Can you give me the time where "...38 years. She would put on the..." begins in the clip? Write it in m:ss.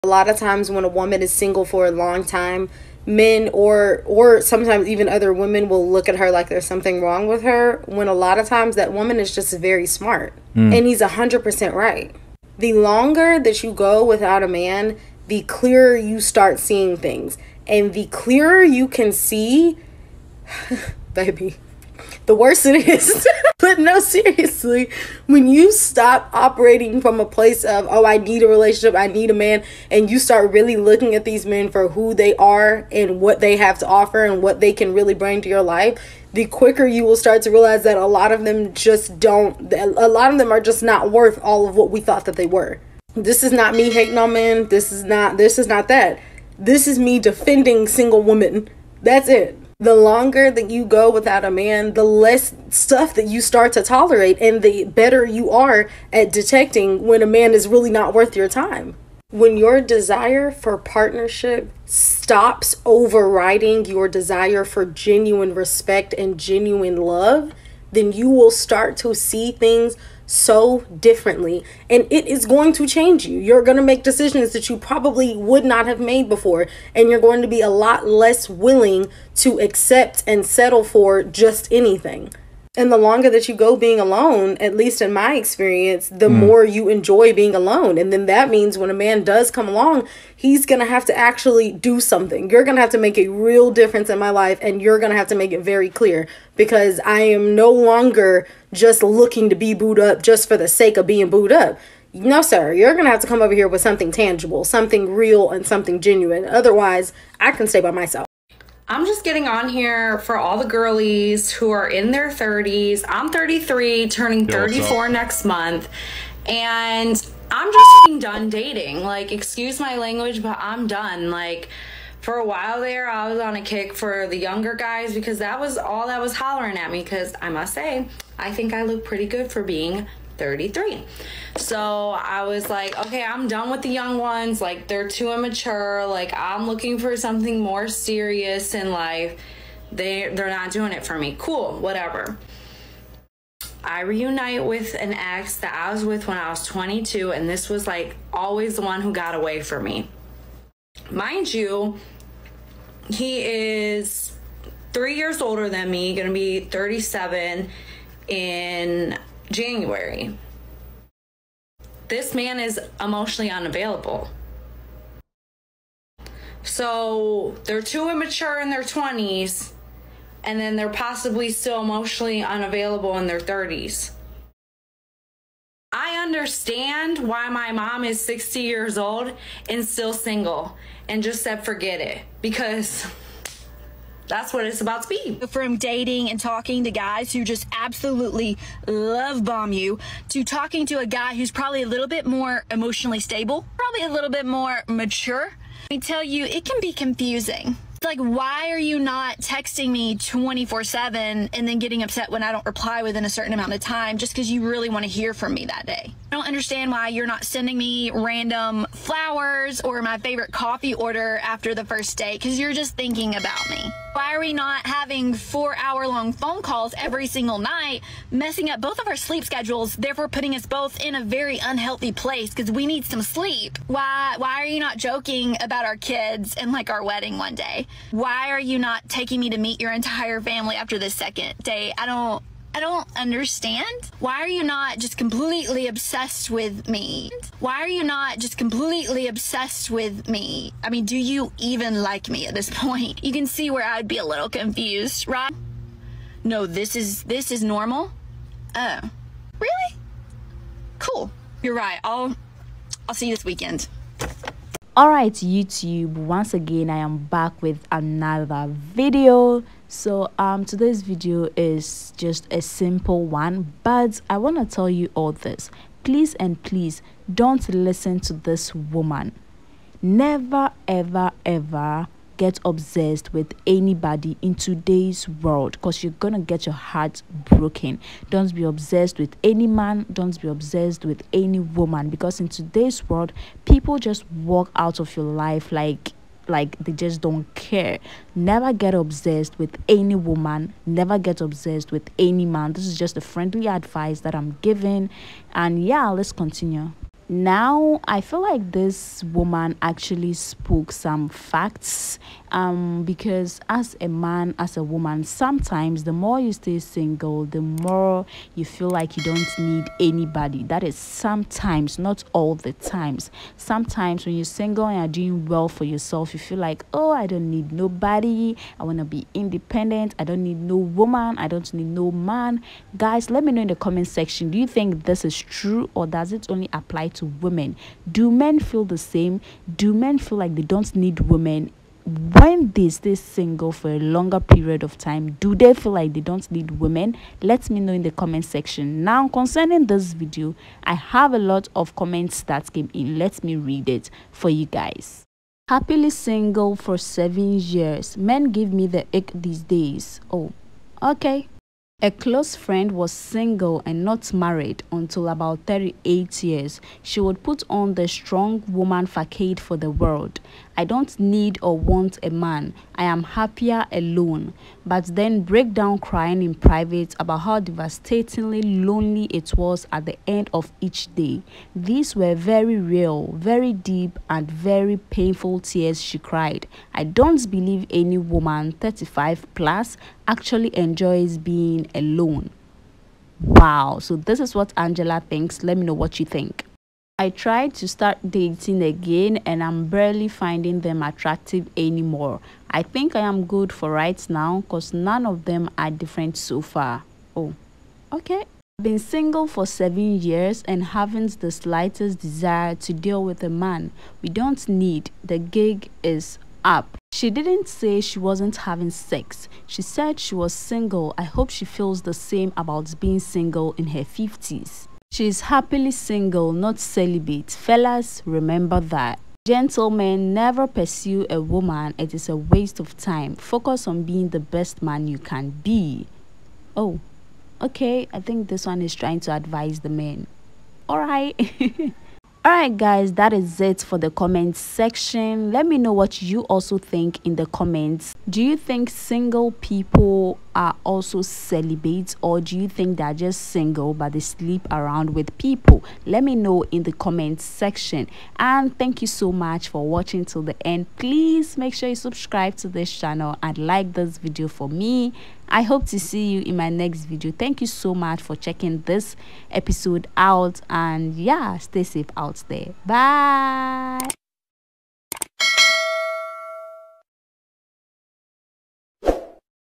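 5:55.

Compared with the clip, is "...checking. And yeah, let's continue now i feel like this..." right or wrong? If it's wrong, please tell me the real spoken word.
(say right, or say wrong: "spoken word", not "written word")
wrong: "giving", not "checking".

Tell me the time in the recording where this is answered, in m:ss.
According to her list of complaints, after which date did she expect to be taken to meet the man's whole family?
3:51.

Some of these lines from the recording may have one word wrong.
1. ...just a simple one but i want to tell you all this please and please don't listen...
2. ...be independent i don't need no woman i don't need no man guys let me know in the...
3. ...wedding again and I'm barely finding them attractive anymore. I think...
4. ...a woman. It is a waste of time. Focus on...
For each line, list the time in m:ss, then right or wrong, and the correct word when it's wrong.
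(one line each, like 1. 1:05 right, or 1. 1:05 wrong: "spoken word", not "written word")
1. 4:22 right
2. 5:19 right
3. 6:28 wrong: "dating", not "wedding"
4. 7:01 right.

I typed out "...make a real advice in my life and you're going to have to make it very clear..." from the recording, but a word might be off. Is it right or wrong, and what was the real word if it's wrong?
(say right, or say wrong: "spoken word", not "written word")
wrong: "difference", not "advice".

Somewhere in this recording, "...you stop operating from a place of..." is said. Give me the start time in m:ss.
0:25.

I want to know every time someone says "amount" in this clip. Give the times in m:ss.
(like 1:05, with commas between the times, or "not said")
3:23.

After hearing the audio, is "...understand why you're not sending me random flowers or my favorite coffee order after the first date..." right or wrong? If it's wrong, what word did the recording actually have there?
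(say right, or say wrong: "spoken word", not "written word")
right.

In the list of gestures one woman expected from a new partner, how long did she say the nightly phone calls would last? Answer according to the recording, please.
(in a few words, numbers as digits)
4 hours.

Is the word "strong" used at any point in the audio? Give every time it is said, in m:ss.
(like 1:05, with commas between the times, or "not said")
5:58.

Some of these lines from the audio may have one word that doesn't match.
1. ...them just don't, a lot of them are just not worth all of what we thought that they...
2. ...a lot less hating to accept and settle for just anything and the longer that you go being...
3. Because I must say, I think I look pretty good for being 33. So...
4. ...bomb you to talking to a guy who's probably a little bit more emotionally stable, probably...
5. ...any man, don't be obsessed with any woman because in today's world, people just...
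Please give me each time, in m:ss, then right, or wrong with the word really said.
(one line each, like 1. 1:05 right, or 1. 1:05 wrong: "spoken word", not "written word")
1. 0:38 right
2. 1:17 wrong: "willing", not "hating"
3. 2:07 right
4. 3:09 right
5. 4:39 right.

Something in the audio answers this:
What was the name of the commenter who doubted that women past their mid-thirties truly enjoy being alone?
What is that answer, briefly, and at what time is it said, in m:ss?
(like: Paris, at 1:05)
Angela, at 6:24.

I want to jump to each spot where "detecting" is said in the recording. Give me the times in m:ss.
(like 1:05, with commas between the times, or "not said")
0:56.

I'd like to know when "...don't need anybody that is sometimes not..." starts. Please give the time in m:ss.
5:09.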